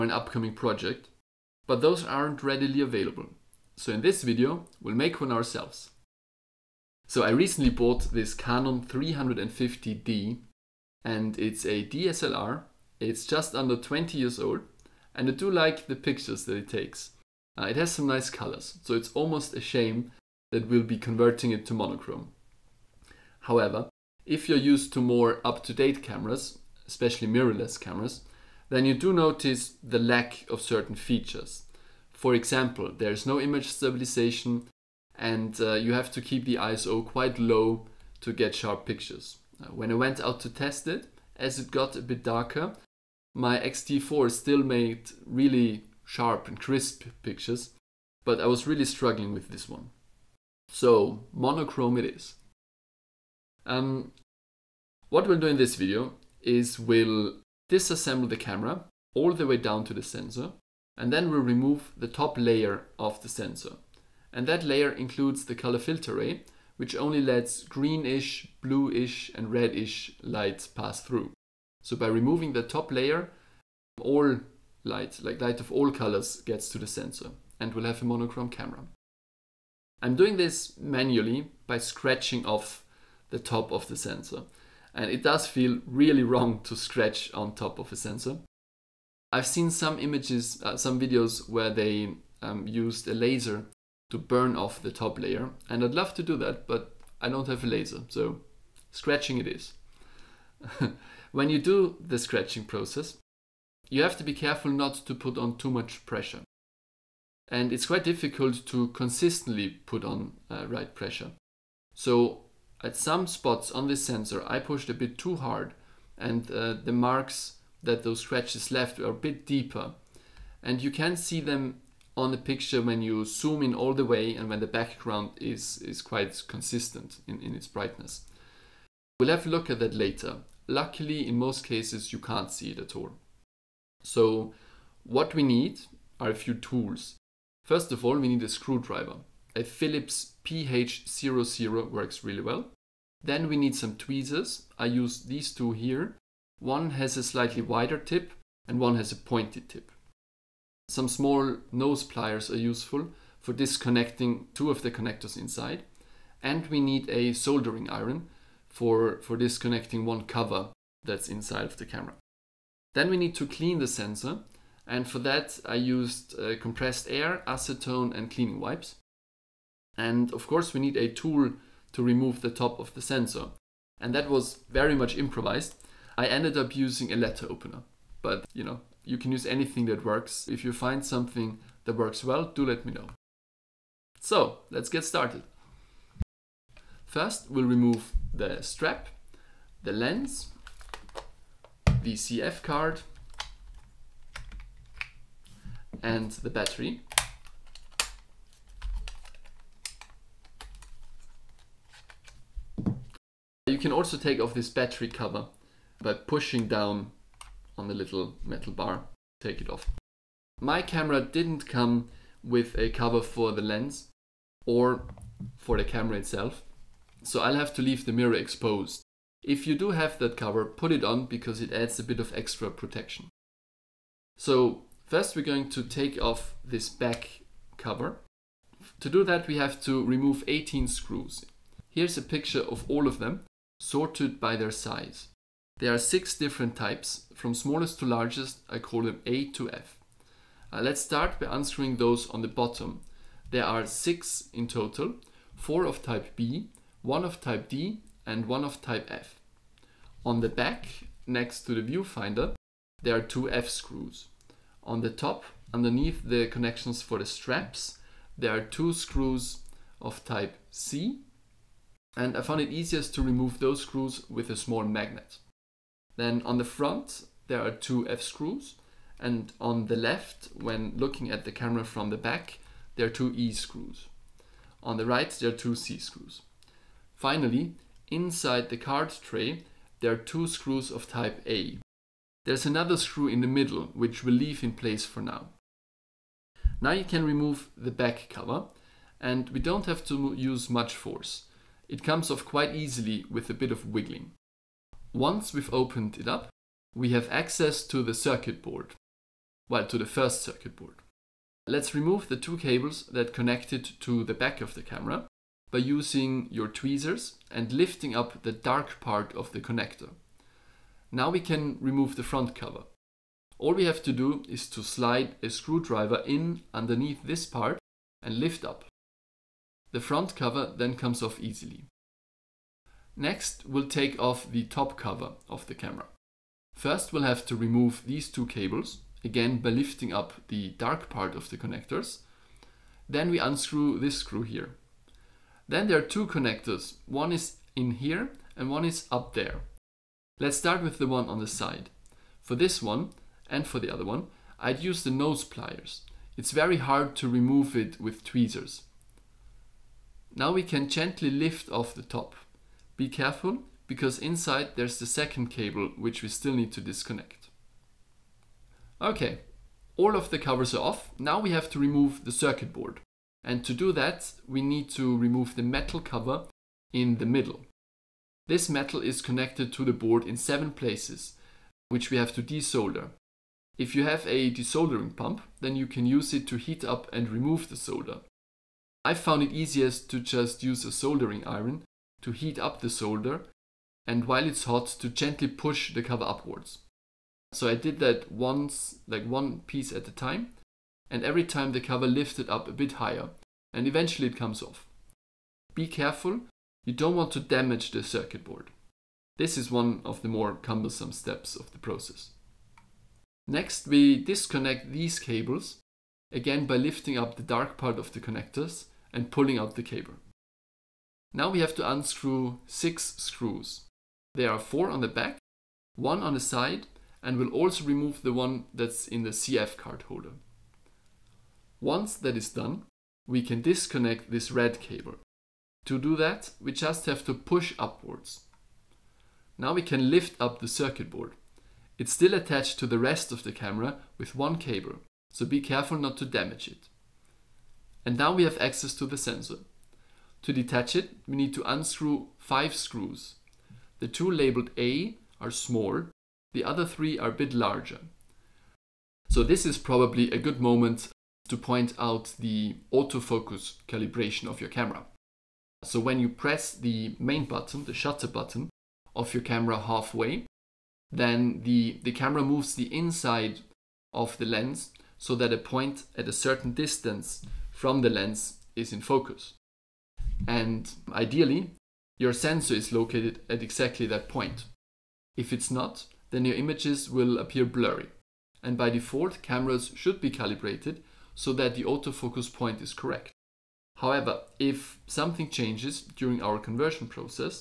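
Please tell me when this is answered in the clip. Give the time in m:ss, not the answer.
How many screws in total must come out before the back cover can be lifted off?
3:50.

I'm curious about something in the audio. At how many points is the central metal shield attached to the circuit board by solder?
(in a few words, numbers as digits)
7.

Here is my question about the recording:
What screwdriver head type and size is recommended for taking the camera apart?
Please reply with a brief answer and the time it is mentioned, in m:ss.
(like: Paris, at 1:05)
Phillips PH00, at 2:19.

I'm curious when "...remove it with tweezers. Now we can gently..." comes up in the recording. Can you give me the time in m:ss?
5:47.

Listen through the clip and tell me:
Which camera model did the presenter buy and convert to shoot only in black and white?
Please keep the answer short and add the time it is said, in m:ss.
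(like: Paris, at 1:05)
Canon 350D, at 0:08.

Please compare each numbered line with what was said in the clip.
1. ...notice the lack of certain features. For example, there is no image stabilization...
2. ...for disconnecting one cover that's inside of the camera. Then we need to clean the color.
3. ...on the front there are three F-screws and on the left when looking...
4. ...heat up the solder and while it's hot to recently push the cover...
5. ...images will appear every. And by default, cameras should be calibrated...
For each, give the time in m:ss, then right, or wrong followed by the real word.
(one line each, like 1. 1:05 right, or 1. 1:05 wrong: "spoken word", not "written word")
1. 0:29 right
2. 2:39 wrong: "sensor", not "color"
3. 4:26 wrong: "two", not "three"
4. 6:22 wrong: "gently", not "recently"
5. 7:56 wrong: "blurry", not "every".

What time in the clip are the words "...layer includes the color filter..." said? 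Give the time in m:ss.
1:04.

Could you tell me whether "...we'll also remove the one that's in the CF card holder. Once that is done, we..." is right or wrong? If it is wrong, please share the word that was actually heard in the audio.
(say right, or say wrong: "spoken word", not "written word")
right.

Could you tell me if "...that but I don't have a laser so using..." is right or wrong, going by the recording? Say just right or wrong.
wrong.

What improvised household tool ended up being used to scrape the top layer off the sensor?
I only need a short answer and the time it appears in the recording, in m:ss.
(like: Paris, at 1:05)
A letter opener, at 2:57.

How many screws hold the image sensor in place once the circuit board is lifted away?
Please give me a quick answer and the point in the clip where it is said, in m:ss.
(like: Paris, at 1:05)
5, at 7:22.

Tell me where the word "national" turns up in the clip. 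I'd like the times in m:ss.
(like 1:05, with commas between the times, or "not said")
not said.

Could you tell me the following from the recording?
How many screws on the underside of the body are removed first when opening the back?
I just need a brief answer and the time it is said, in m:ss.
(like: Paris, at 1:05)
6, at 4:03.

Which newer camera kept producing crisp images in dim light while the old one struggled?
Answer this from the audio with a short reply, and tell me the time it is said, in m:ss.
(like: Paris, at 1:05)
X-T4, at 0:43.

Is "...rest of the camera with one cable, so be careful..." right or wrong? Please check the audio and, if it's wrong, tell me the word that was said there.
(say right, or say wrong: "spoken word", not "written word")
right.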